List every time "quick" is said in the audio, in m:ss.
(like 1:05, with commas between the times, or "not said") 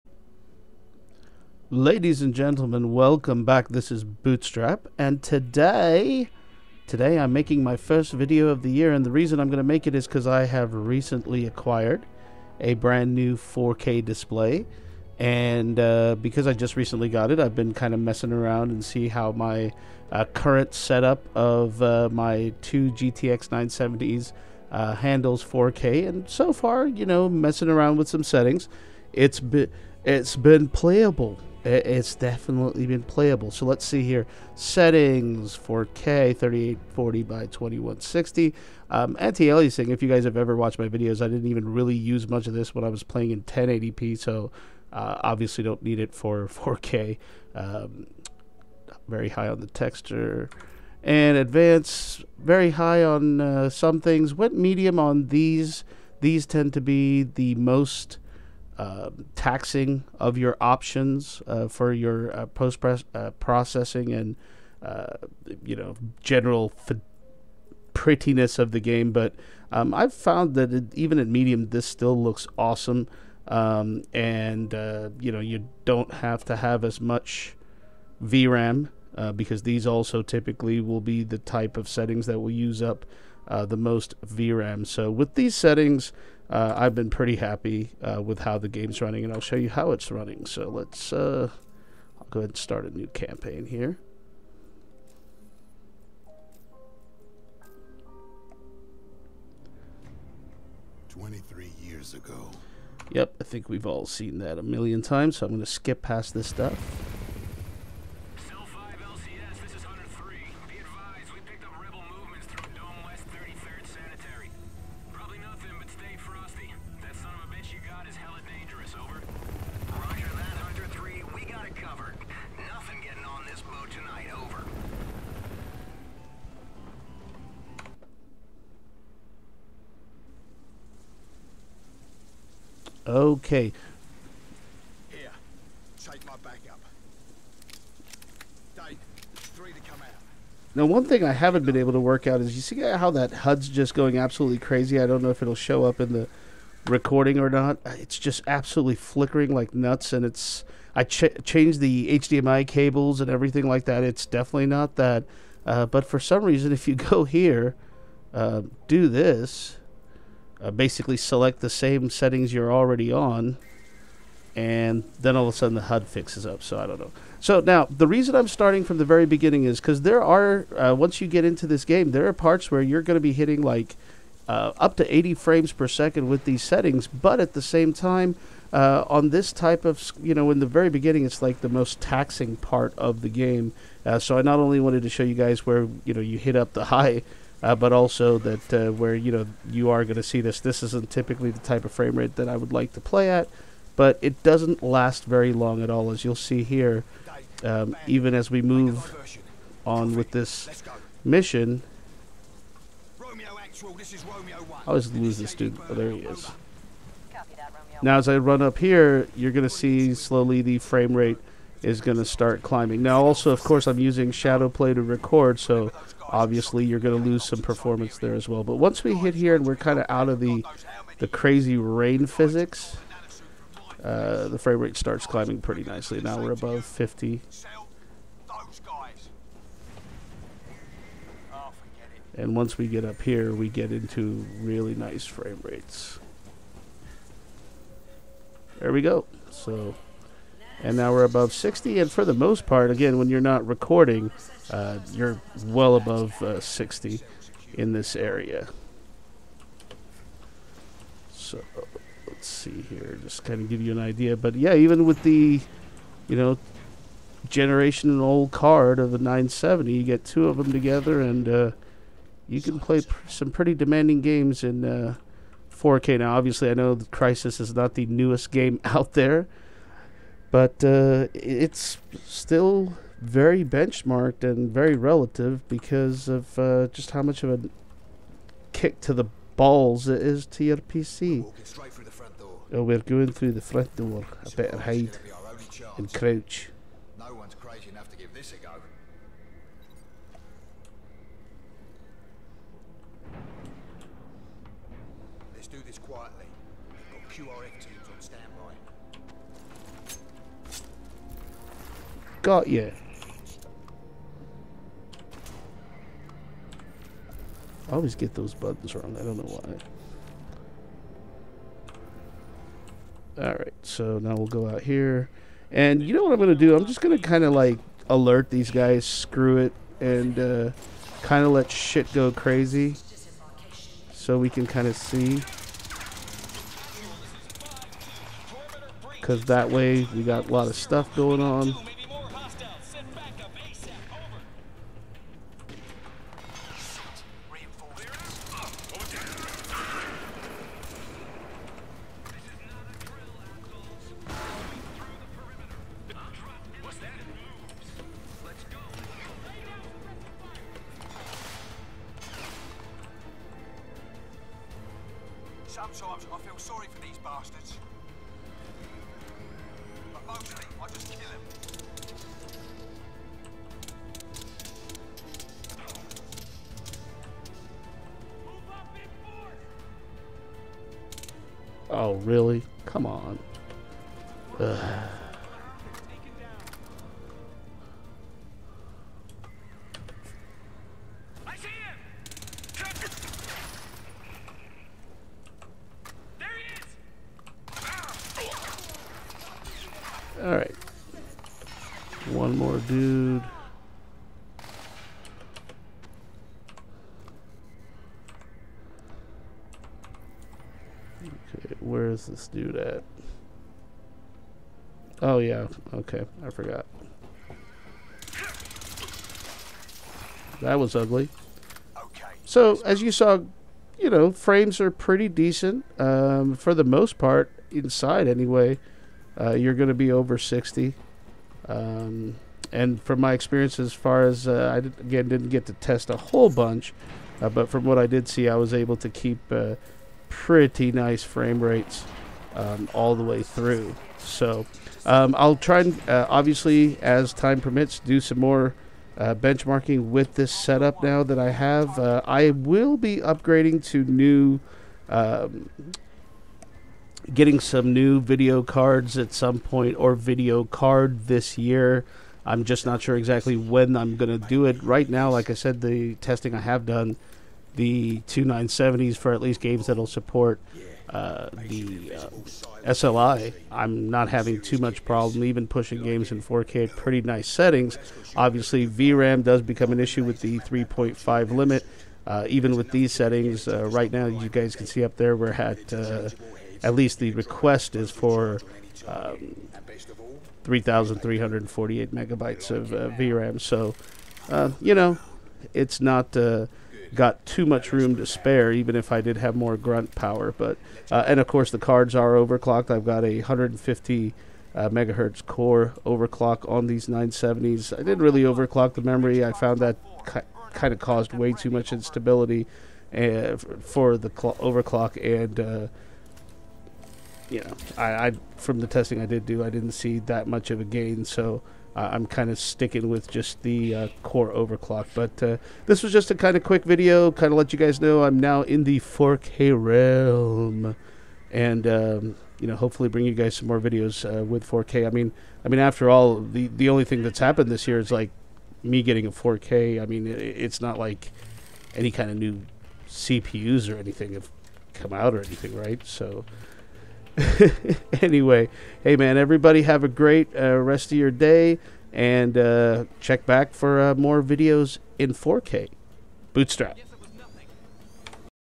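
8:36.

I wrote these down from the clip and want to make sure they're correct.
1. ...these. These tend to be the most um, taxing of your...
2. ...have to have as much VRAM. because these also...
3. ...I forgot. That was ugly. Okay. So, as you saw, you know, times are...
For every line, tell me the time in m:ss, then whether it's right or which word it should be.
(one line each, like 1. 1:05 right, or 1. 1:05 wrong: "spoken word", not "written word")
1. 0:55 right
2. 1:16 right
3. 6:46 wrong: "frames", not "times".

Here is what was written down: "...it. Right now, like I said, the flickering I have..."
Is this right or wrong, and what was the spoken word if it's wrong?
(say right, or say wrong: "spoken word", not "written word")
wrong: "testing", not "flickering".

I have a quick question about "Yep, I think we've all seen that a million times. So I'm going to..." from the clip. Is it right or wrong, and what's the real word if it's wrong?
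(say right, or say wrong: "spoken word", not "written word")
right.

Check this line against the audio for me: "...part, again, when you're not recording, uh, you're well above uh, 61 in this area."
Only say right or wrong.
wrong.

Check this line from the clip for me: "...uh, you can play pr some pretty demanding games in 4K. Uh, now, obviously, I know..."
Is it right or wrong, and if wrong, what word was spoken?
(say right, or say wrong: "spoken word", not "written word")
right.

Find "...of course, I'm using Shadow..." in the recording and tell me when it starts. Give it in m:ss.
3:33.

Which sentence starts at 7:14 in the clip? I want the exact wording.
So um, I'll try and uh, obviously, as time permits, do some more.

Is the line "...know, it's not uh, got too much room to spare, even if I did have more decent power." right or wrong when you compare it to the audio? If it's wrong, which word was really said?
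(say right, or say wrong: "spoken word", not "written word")
wrong: "grunt", not "decent".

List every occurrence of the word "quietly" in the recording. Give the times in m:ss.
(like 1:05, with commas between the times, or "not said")
4:55.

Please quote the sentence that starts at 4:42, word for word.
We're oh, we're going through the front door.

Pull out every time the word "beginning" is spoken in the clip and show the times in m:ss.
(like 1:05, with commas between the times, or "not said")
2:49, 3:00.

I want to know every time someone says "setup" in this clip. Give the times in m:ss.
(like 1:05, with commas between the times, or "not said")
0:20, 7:20.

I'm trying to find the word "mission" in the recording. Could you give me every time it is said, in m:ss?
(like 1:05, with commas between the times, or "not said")
3:21.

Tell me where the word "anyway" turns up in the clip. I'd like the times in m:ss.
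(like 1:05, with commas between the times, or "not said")
6:58, 8:58.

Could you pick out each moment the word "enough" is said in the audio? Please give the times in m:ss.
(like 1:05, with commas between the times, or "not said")
4:47.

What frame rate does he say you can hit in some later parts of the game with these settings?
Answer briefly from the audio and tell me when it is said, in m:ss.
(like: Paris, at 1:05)
80 frames per second, at 2:55.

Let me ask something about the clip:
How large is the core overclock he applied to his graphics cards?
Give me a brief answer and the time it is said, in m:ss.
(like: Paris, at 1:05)
150 MHz, at 8:13.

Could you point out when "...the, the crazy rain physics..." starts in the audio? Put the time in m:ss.
3:40.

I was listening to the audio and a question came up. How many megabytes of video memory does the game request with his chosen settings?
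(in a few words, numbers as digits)
3,348.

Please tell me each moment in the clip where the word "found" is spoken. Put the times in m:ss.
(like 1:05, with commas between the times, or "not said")
1:10, 8:19.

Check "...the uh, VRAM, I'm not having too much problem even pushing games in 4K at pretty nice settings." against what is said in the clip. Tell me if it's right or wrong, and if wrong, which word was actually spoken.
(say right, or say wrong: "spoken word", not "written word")
wrong: "SLI", not "VRAM".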